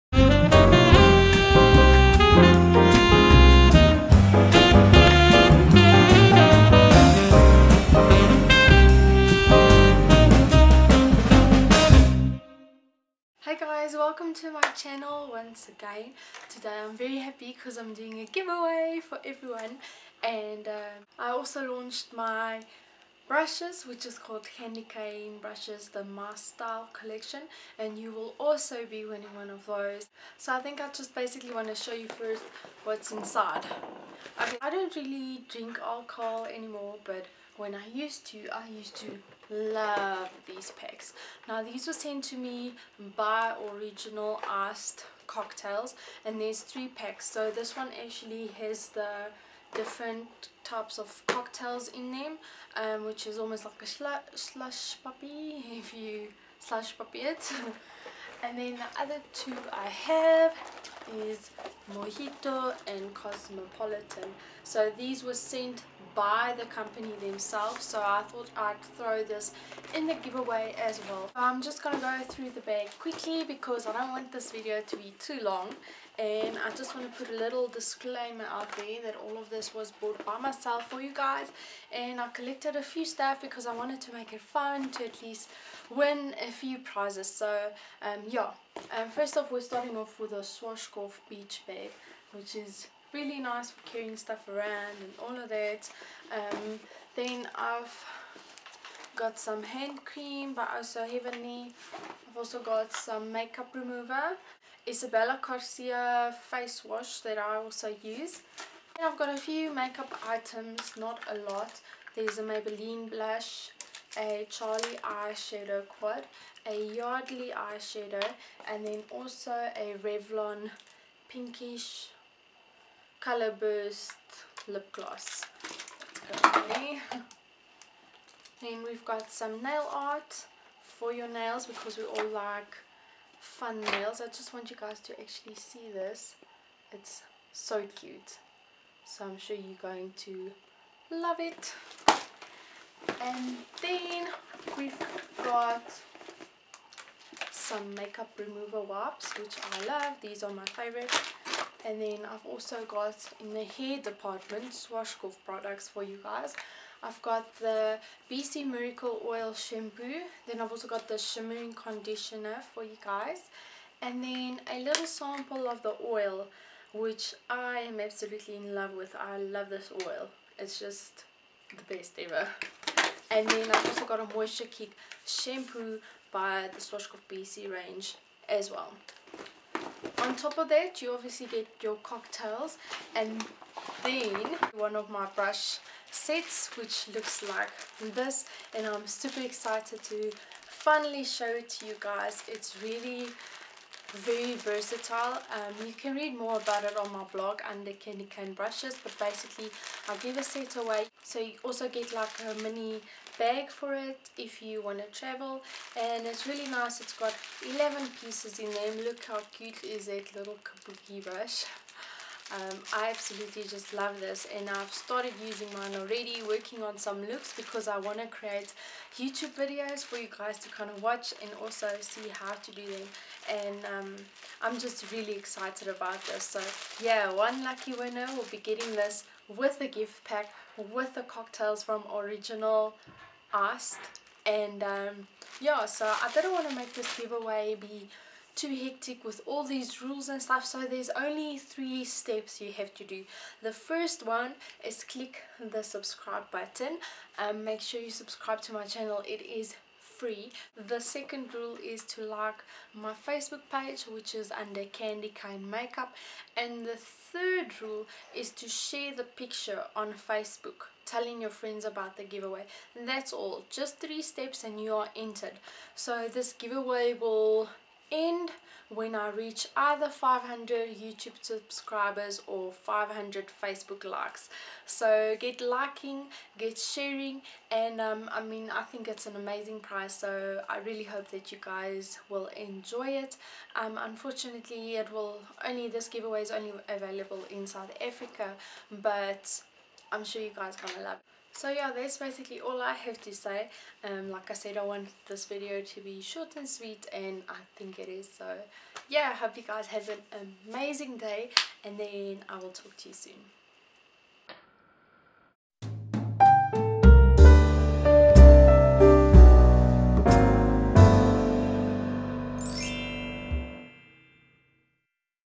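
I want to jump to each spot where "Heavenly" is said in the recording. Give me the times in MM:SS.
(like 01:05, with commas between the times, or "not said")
01:41.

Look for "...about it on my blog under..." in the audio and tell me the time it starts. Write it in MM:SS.
03:16.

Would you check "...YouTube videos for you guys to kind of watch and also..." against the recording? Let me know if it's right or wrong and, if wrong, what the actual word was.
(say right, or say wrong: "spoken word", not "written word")
right.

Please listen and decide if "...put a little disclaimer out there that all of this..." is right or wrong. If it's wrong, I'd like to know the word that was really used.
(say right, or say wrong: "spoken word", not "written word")
right.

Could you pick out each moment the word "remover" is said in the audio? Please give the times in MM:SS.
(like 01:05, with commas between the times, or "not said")
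01:43, 02:28.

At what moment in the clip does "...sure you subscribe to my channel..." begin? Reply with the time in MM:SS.
04:07.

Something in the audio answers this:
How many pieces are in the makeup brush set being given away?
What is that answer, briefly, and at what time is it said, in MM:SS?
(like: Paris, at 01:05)
11, at 03:27.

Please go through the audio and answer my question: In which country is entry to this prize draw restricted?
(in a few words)
South Africa.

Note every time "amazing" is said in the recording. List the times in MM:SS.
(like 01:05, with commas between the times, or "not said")
04:39, 05:00.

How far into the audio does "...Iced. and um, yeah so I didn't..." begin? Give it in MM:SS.
03:53.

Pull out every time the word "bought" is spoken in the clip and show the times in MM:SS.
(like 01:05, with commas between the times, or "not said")
01:19.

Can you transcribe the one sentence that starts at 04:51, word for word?
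So yeah, that's basically all I have to say.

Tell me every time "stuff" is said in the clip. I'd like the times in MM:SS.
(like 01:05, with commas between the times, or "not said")
01:23, 01:34, 04:00.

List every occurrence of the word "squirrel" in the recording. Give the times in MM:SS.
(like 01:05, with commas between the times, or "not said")
not said.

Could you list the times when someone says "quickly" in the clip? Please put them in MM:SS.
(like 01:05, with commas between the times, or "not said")
01:12.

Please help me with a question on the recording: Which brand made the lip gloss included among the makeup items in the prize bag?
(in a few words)
Revlon.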